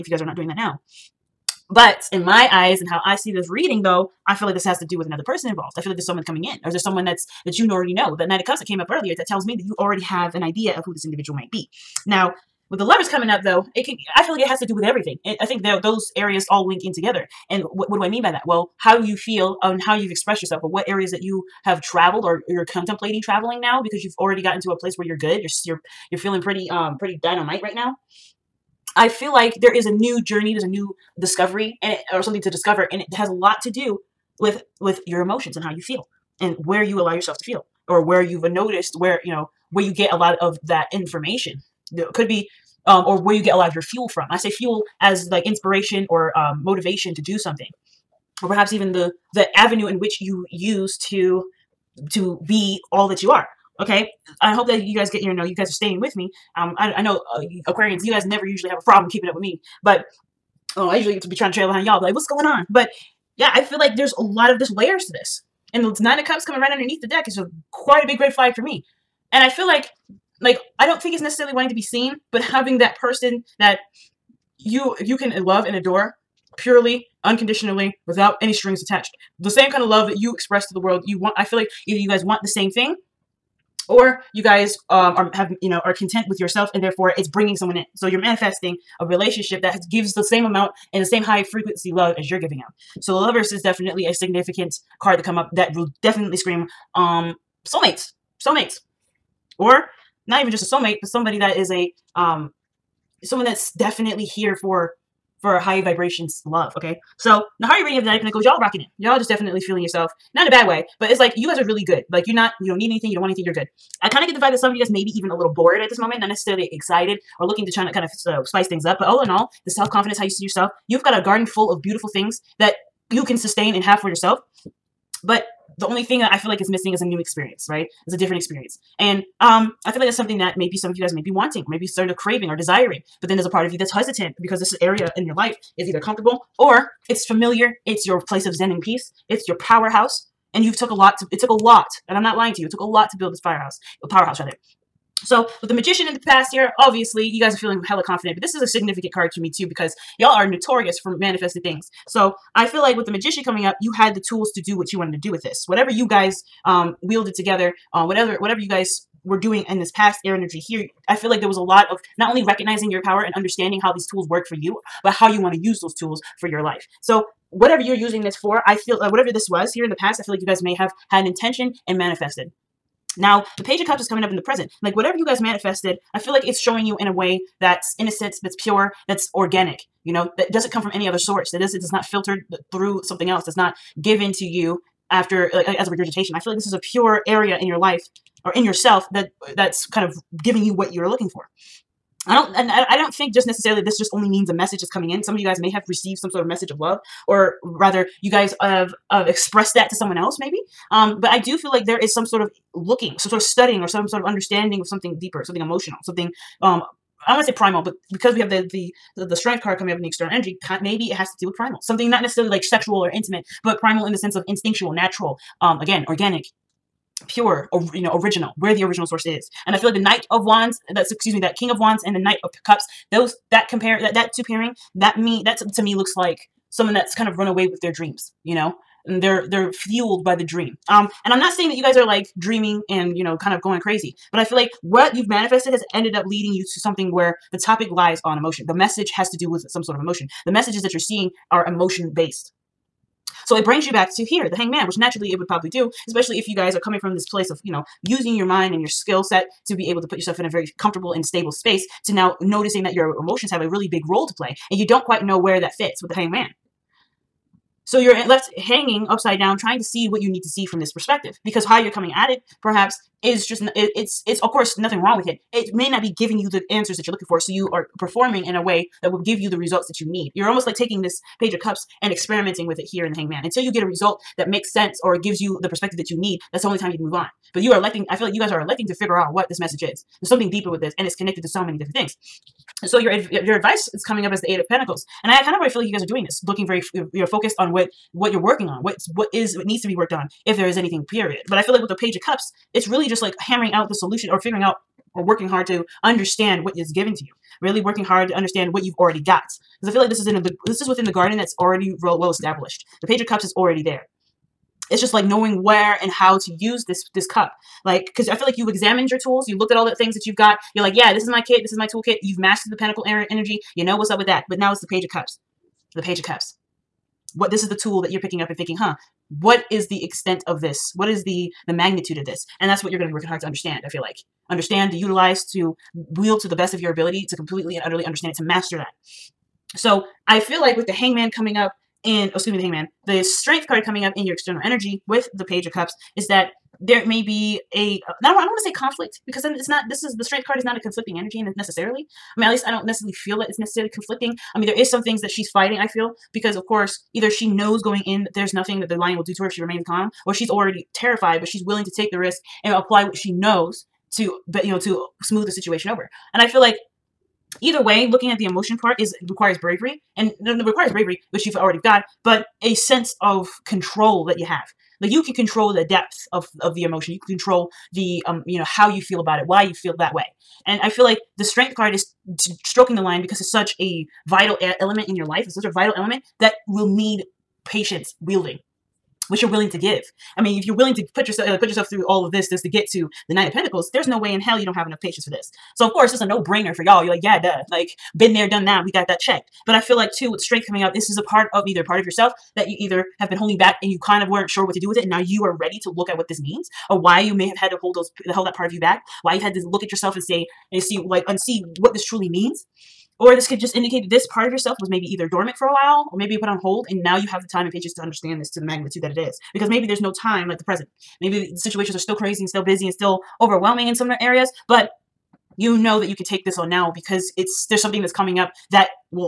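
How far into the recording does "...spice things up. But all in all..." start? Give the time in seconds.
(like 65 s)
118 s.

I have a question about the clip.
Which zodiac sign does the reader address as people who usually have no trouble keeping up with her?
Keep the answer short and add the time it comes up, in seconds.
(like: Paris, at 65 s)
Aquarians, at 57 s.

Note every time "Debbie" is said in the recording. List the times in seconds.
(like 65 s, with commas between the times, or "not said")
not said.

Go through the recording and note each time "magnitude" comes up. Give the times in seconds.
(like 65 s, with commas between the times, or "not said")
321 s, 408 s.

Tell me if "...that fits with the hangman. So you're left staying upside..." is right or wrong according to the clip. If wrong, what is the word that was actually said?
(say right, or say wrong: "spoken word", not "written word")
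wrong: "hanging", not "staying".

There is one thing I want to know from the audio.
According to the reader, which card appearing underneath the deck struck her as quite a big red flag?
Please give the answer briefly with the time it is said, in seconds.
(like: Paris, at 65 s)
Nine of Cups, at 65 s.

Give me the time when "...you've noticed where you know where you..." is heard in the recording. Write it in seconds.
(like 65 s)
38 s.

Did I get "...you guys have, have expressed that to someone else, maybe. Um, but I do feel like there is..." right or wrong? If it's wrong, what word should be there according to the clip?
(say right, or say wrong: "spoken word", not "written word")
right.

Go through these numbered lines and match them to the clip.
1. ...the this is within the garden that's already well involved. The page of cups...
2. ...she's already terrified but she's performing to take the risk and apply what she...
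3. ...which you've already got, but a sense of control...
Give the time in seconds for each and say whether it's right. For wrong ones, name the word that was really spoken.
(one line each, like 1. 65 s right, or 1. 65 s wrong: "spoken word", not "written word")
1. 300 s wrong: "established", not "involved"
2. 350 s wrong: "willing", not "performing"
3. 361 s right.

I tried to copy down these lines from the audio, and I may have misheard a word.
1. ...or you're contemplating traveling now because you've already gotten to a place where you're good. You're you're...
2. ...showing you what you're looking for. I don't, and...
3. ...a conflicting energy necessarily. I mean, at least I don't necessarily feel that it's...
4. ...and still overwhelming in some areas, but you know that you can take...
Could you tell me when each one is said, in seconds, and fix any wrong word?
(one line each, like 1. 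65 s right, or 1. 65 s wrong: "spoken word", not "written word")
1. 22 s right
2. 190 s wrong: "giving", not "showing"
3. 340 s right
4. 412 s right.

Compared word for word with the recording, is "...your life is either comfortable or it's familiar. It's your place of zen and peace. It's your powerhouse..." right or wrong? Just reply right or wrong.
right.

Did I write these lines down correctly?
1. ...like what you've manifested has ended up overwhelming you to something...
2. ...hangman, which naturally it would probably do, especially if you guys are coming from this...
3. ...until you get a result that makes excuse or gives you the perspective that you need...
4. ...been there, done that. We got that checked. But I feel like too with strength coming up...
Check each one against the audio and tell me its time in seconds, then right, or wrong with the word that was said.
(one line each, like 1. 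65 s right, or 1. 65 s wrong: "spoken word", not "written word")
1. 234 s wrong: "leading", not "overwhelming"
2. 244 s right
3. 273 s wrong: "sense", not "excuse"
4. 388 s right.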